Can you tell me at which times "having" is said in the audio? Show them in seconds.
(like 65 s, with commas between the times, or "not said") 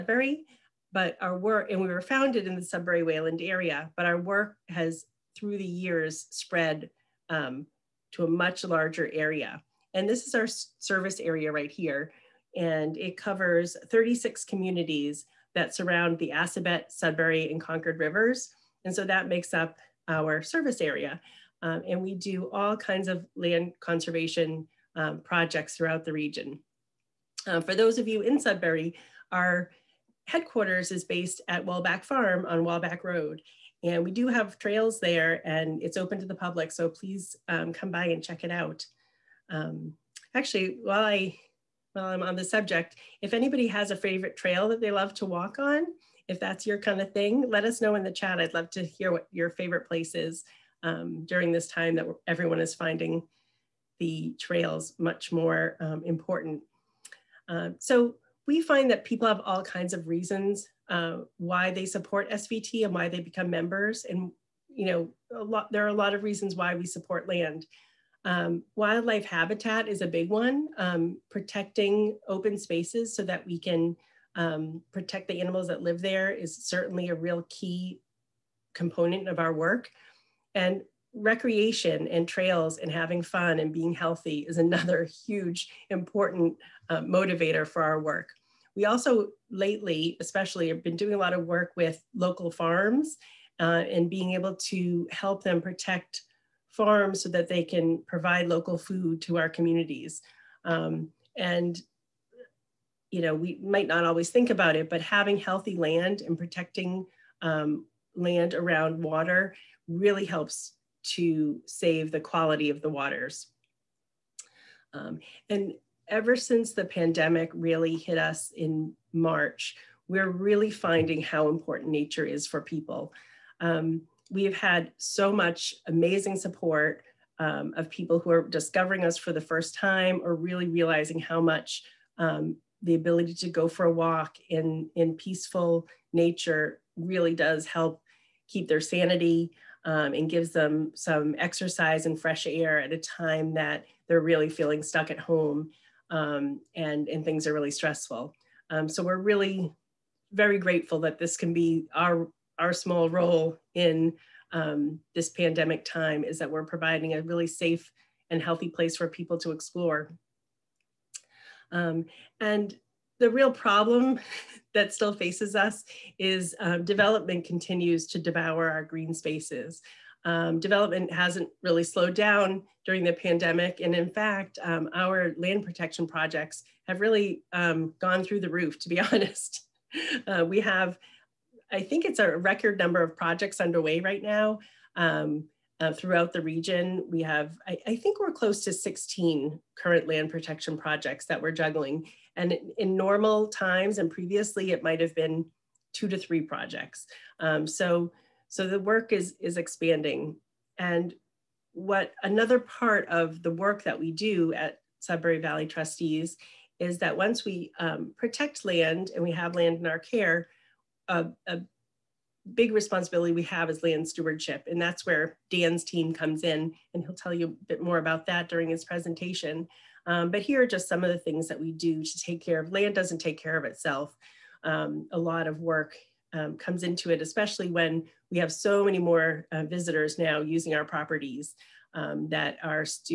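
82 s, 104 s.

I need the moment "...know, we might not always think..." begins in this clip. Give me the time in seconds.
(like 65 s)
103 s.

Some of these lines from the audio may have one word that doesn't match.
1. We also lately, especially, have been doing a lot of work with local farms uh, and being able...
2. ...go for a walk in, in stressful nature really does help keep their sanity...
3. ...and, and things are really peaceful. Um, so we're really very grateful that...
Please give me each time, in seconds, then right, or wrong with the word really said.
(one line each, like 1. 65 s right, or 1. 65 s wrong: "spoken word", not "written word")
1. 88 s right
2. 133 s wrong: "peaceful", not "stressful"
3. 146 s wrong: "stressful", not "peaceful".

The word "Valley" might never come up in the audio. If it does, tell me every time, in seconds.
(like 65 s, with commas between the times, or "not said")
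205 s.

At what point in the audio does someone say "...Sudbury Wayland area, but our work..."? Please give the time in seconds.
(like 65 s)
2 s.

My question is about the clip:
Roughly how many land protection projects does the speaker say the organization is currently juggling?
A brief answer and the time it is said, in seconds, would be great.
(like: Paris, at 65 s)
16, at 188 s.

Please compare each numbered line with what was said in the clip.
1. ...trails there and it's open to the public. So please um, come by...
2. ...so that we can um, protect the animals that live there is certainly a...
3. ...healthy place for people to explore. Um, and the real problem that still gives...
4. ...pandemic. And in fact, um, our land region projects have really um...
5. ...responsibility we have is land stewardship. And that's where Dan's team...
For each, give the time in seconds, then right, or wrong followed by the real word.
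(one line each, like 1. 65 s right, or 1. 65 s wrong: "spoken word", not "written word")
1. 34 s right
2. 73 s right
3. 158 s wrong: "faces", not "gives"
4. 173 s wrong: "protection", not "region"
5. 212 s right.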